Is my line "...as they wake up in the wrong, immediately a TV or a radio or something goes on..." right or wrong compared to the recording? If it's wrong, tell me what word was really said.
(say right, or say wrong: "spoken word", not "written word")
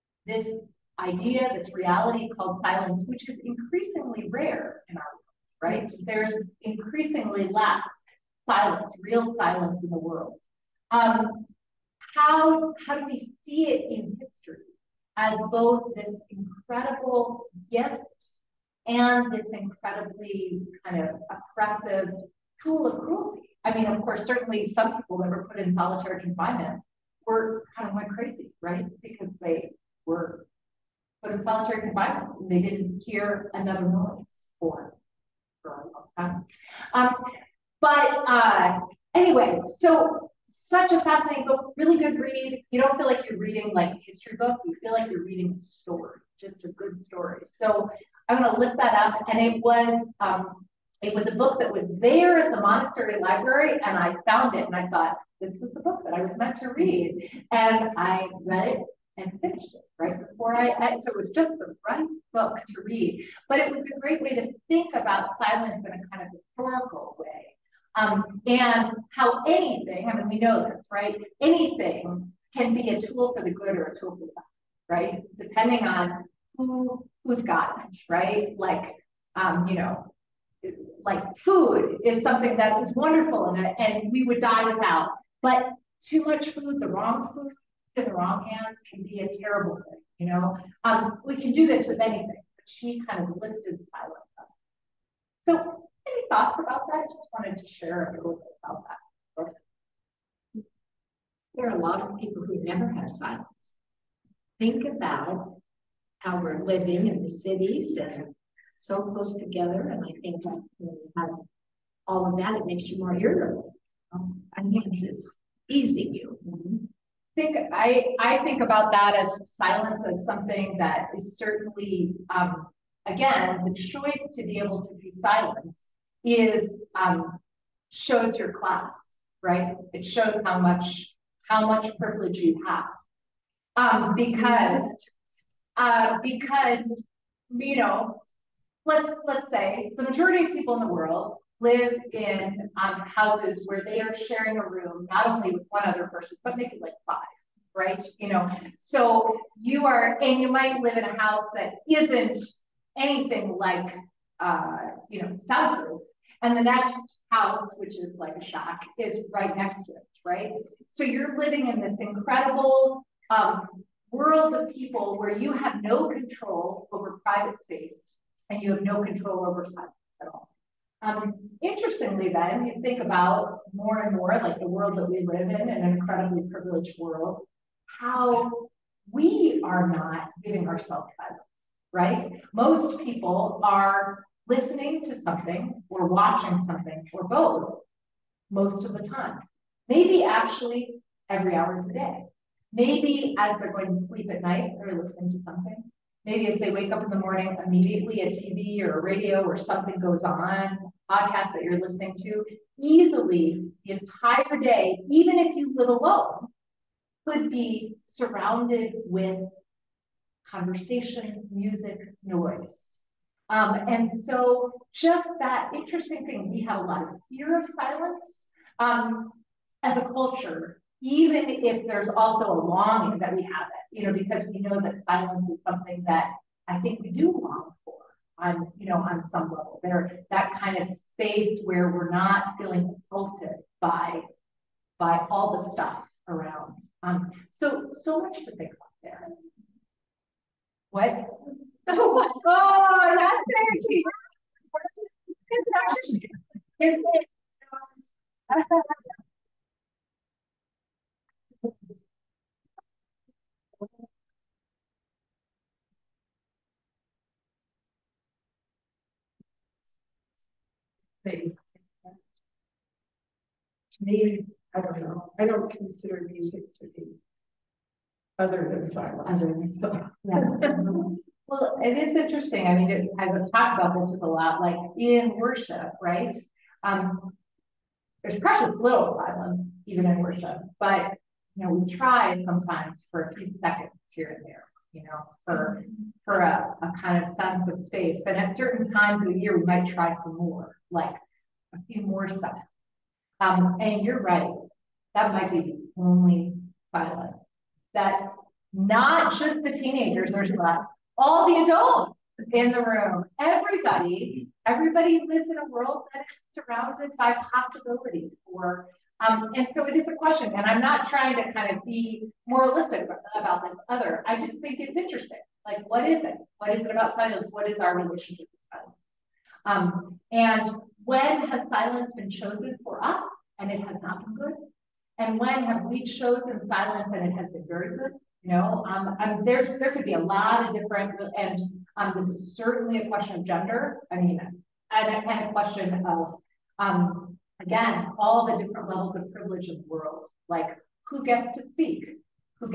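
wrong: "morning", not "wrong".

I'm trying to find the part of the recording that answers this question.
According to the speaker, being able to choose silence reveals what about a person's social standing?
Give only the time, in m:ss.
2:08.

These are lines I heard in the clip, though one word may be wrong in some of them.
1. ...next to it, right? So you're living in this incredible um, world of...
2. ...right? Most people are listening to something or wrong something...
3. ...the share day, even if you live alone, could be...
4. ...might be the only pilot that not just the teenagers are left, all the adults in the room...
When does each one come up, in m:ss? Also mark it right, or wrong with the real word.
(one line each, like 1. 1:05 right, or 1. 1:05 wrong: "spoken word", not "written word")
1. 2:39 right
2. 3:01 wrong: "watching", not "wrong"
3. 3:23 wrong: "entire", not "share"
4. 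4:55 right.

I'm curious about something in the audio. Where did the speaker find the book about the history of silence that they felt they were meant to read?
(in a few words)
monastery library.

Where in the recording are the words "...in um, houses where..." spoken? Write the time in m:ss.
2:22.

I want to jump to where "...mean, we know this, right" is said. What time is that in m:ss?
1:10.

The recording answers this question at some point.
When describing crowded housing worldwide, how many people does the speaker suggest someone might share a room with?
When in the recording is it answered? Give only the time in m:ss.
2:27.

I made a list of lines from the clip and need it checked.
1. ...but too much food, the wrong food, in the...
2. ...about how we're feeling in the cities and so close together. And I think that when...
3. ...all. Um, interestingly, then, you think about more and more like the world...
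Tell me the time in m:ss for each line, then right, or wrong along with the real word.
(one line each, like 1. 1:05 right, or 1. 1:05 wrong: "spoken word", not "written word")
1. 1:25 right
2. 1:44 wrong: "living", not "feeling"
3. 2:50 right.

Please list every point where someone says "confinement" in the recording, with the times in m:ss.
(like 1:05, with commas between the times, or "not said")
0:26, 0:31.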